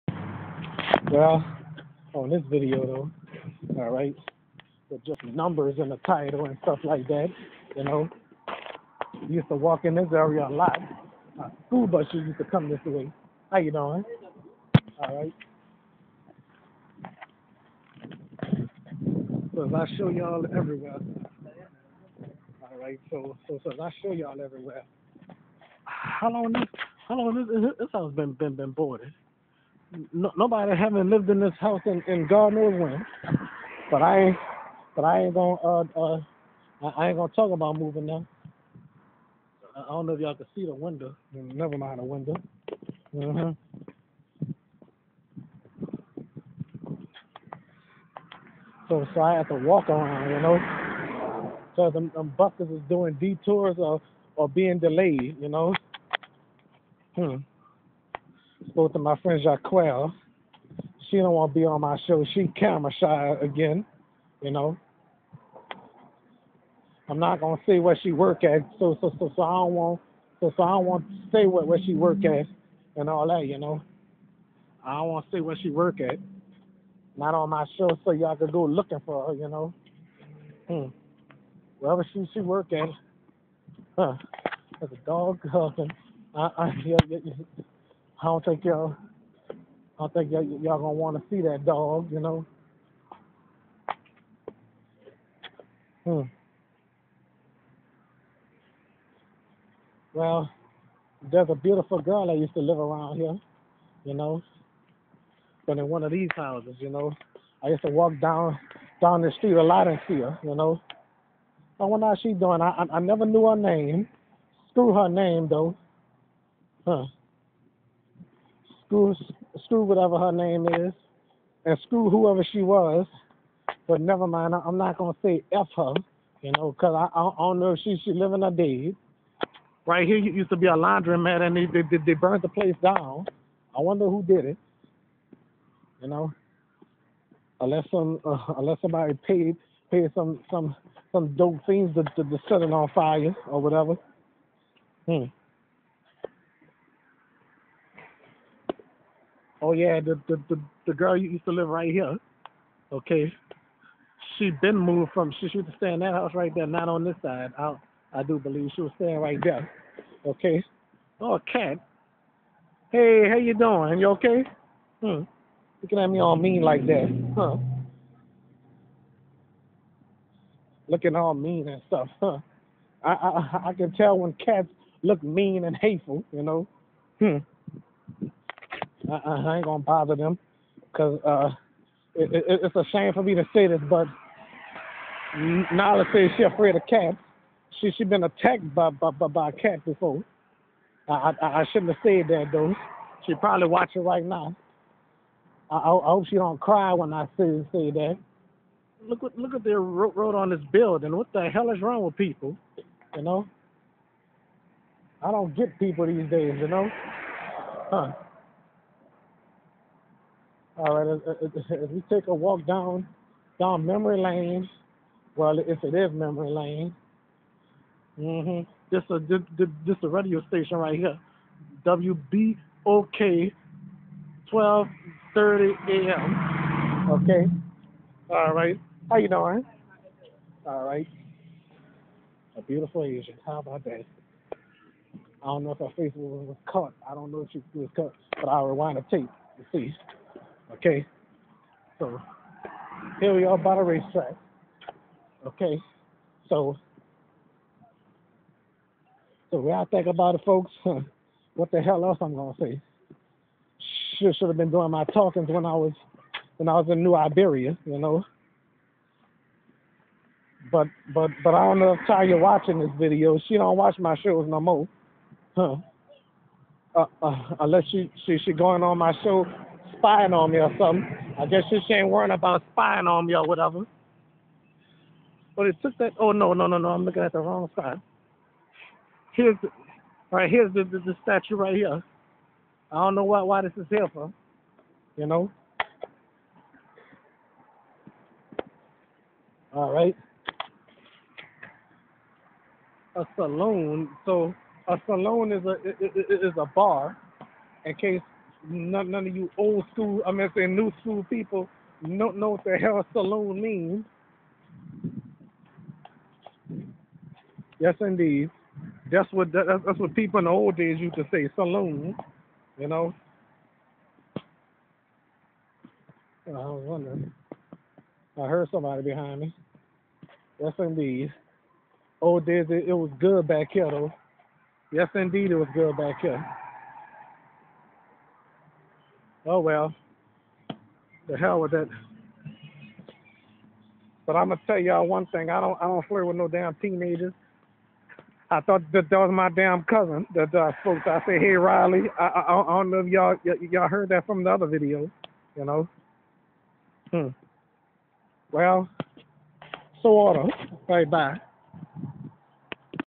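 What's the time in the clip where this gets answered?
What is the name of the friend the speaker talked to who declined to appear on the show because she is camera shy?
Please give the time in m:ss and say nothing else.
0:59.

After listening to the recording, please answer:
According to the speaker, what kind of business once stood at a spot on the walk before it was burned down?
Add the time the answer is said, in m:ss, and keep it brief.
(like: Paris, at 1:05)
Laundromat, at 2:10.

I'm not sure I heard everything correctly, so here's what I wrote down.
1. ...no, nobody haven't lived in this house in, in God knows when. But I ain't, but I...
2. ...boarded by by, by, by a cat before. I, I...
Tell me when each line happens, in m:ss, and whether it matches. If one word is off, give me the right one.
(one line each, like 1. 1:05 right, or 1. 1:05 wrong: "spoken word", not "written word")
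1. 0:30 right
2. 3:08 wrong: "attacked", not "boarded".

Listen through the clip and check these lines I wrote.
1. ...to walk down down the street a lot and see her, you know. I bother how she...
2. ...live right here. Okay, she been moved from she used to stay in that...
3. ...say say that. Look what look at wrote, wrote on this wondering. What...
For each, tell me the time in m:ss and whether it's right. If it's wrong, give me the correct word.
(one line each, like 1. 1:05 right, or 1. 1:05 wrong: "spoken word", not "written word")
1. 1:47 wrong: "wonder", not "bother"
2. 2:31 right
3. 3:17 wrong: "building", not "wondering".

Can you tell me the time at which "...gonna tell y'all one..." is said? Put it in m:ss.
5:34.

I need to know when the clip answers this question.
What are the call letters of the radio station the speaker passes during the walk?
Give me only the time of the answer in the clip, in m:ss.
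3:41.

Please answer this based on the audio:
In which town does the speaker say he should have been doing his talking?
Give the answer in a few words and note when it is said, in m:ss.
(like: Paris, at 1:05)
New Iberia, at 4:17.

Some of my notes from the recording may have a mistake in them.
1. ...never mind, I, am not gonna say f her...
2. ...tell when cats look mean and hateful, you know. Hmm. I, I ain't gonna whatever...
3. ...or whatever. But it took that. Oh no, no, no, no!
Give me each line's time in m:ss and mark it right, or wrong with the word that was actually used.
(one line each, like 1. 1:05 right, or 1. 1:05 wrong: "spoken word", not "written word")
1. 2:04 right
2. 2:53 wrong: "bother", not "whatever"
3. 4:33 right.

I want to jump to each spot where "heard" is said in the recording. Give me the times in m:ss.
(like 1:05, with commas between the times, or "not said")
5:18, 5:43.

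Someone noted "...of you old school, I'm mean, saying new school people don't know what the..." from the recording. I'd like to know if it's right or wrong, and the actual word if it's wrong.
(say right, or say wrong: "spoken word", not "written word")
right.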